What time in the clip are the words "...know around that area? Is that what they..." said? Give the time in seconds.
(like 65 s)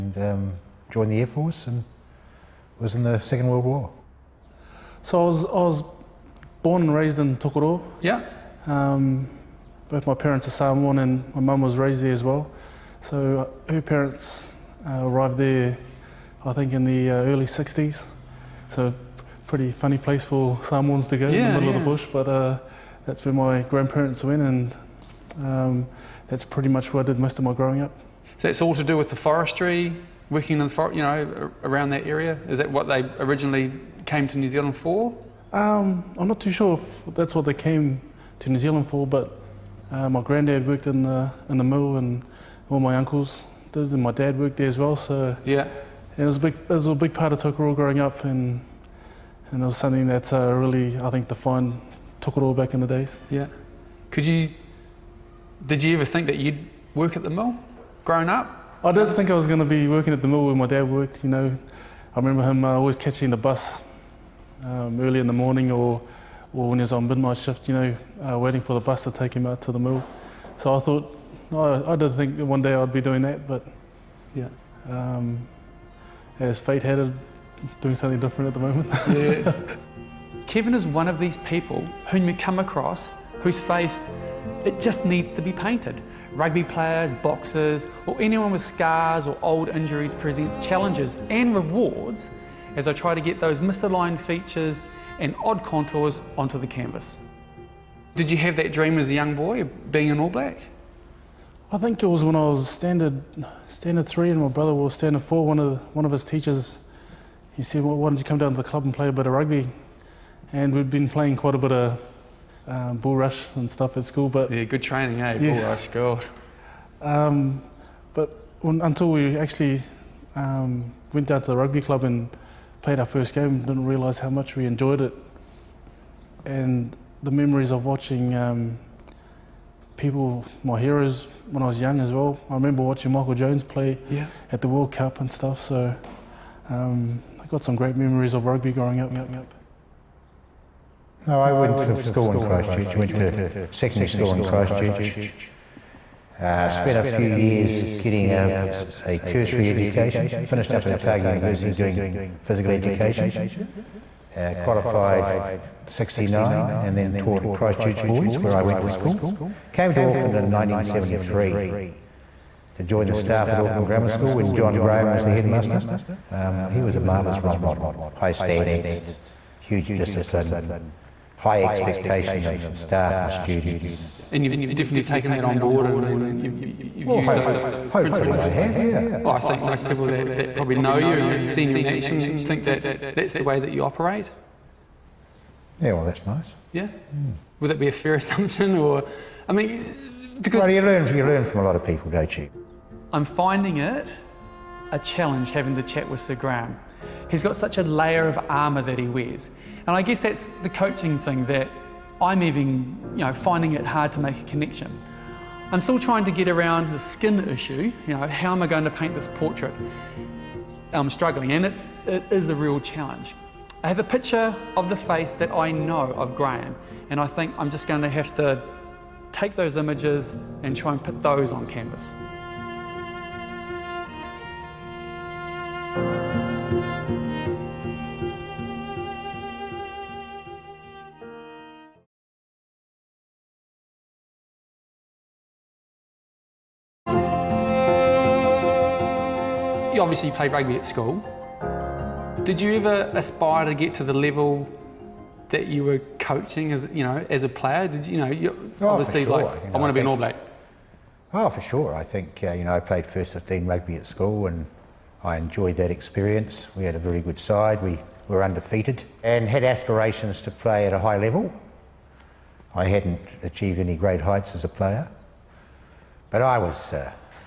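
31 s.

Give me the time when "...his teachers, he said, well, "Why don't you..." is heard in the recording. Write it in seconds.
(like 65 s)
106 s.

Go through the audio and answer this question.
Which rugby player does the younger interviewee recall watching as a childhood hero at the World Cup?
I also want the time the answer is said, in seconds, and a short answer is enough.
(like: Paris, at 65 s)
Michael Jones, at 133 s.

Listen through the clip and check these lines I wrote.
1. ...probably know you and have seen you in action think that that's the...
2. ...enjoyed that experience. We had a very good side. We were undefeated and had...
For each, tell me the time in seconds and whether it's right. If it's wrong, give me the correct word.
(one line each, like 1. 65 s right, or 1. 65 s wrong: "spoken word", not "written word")
1. 180 s right
2. 255 s right.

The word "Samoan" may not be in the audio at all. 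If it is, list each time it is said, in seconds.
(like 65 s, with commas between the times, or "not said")
10 s, 20 s.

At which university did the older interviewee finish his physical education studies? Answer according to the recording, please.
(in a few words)
Otago University.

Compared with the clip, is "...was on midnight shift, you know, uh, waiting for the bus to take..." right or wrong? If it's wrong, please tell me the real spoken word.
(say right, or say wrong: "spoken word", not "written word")
right.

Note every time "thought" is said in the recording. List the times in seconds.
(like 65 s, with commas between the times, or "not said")
70 s.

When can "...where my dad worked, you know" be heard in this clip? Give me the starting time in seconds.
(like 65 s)
60 s.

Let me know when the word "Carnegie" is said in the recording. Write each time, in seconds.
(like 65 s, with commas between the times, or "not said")
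not said.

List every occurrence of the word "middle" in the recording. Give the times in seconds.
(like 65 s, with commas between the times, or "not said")
21 s.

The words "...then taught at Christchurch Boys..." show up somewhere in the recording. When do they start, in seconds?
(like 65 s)
156 s.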